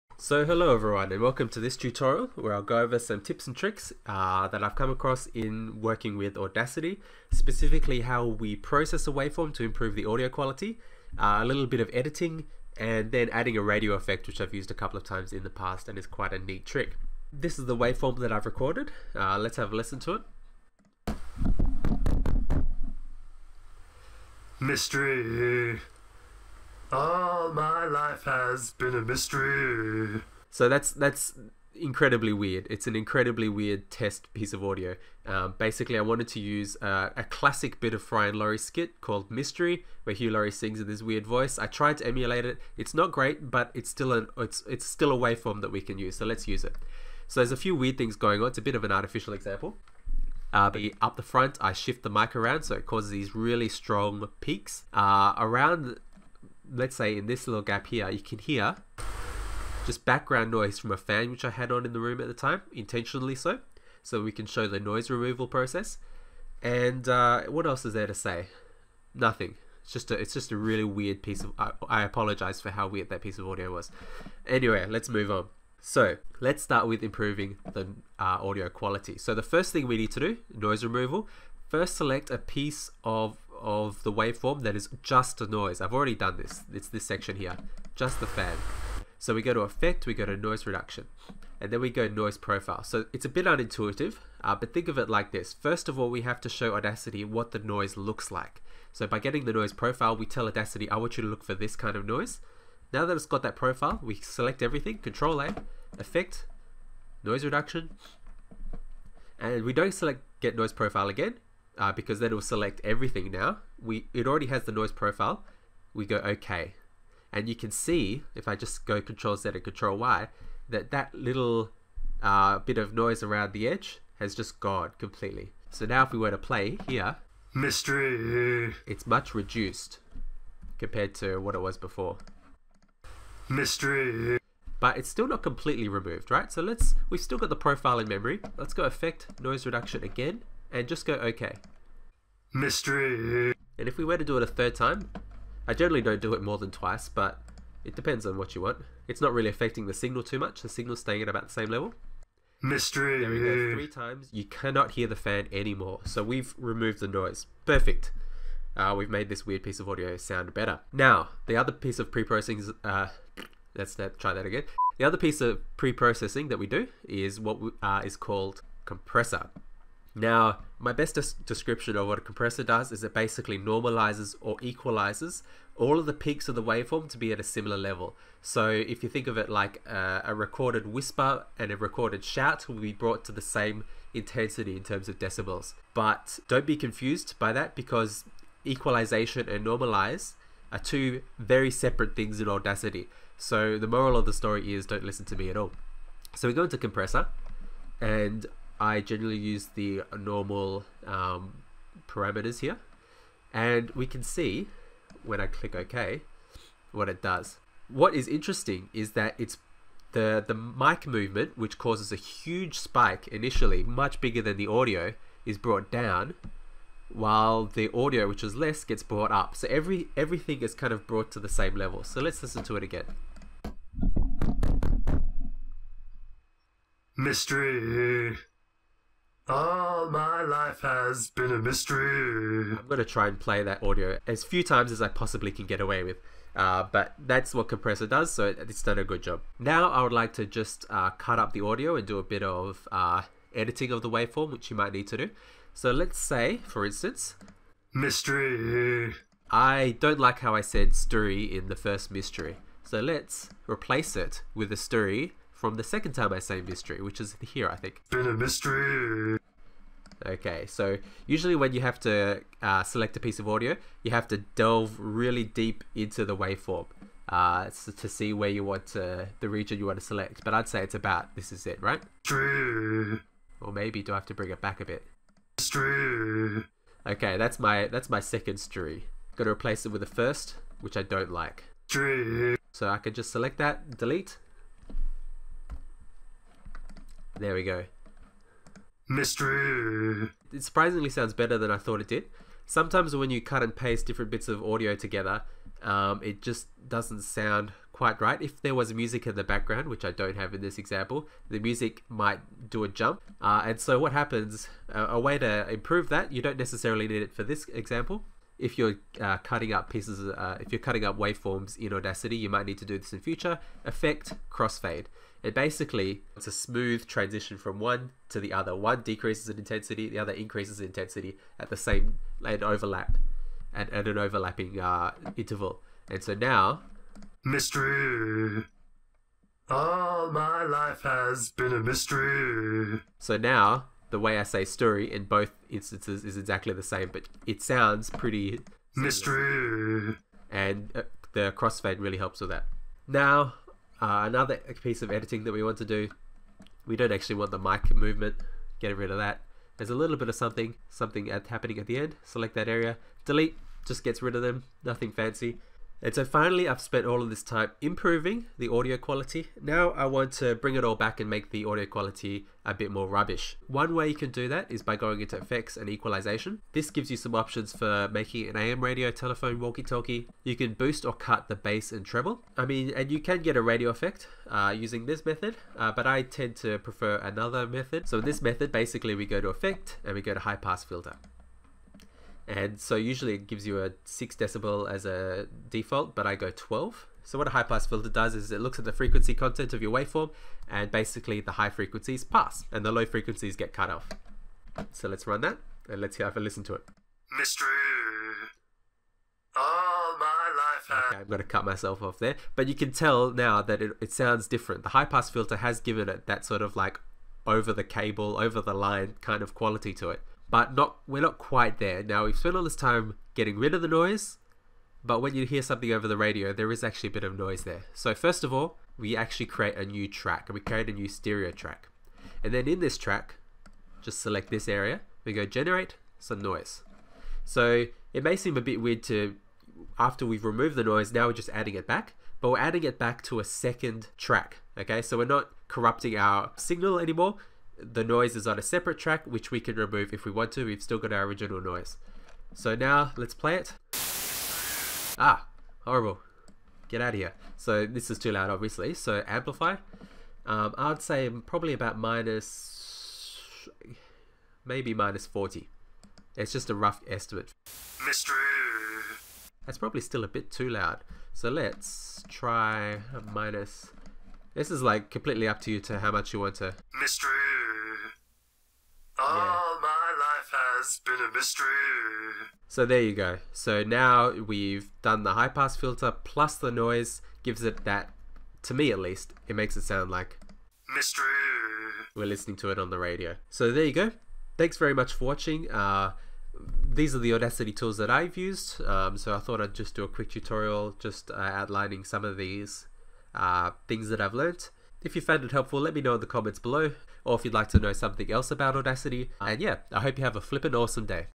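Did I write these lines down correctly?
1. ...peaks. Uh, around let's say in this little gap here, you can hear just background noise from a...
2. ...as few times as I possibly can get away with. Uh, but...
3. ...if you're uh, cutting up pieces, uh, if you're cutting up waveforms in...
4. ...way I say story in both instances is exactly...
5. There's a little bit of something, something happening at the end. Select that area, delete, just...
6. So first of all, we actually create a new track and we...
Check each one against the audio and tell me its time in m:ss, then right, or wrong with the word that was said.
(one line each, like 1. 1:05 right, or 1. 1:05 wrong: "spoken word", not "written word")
1. 0:54 right
2. 3:54 right
3. 5:08 right
4. 5:34 right
5. 5:49 right
6. 6:57 right.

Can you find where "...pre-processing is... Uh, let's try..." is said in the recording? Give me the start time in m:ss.
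2:42.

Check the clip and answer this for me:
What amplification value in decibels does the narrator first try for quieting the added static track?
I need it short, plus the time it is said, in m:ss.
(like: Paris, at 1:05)
-40, at 7:34.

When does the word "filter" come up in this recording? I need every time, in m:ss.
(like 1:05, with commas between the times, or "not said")
6:20, 6:27, 6:45, 7:55.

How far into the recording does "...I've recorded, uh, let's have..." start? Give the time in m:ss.
0:18.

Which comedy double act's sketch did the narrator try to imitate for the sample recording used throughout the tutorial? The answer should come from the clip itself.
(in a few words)
Fry and Laurie.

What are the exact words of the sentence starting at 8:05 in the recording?
Uh, these are the Audacity tools that I've used.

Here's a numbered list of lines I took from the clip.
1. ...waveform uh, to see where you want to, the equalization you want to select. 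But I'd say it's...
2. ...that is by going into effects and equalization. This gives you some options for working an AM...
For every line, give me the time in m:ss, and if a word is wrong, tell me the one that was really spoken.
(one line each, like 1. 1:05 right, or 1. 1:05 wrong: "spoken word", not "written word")
1. 4:26 wrong: "region", not "equalization"
2. 6:04 wrong: "making", not "working".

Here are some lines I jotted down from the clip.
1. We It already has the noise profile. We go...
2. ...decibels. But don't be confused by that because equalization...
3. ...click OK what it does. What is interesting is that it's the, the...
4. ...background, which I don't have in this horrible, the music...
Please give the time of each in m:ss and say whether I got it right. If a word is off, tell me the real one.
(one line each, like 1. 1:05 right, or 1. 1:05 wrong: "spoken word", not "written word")
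1. 1:53 right
2. 3:05 right
3. 3:25 right
4. 4:59 wrong: "example", not "horrible".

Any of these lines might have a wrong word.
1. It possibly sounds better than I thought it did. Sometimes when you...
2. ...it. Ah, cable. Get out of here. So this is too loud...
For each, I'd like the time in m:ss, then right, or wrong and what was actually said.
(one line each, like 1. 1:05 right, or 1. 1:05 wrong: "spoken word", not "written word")
1. 4:50 wrong: "surprisingly", not "possibly"
2. 7:23 wrong: "horrible", not "cable".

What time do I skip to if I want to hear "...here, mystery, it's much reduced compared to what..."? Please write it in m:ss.
2:06.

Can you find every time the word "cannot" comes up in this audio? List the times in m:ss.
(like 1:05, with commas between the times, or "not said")
2:34.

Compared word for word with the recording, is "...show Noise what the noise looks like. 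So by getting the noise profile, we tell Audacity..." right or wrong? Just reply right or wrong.
wrong.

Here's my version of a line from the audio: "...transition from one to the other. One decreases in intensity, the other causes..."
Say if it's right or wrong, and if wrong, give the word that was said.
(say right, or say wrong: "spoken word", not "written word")
wrong: "increases", not "causes".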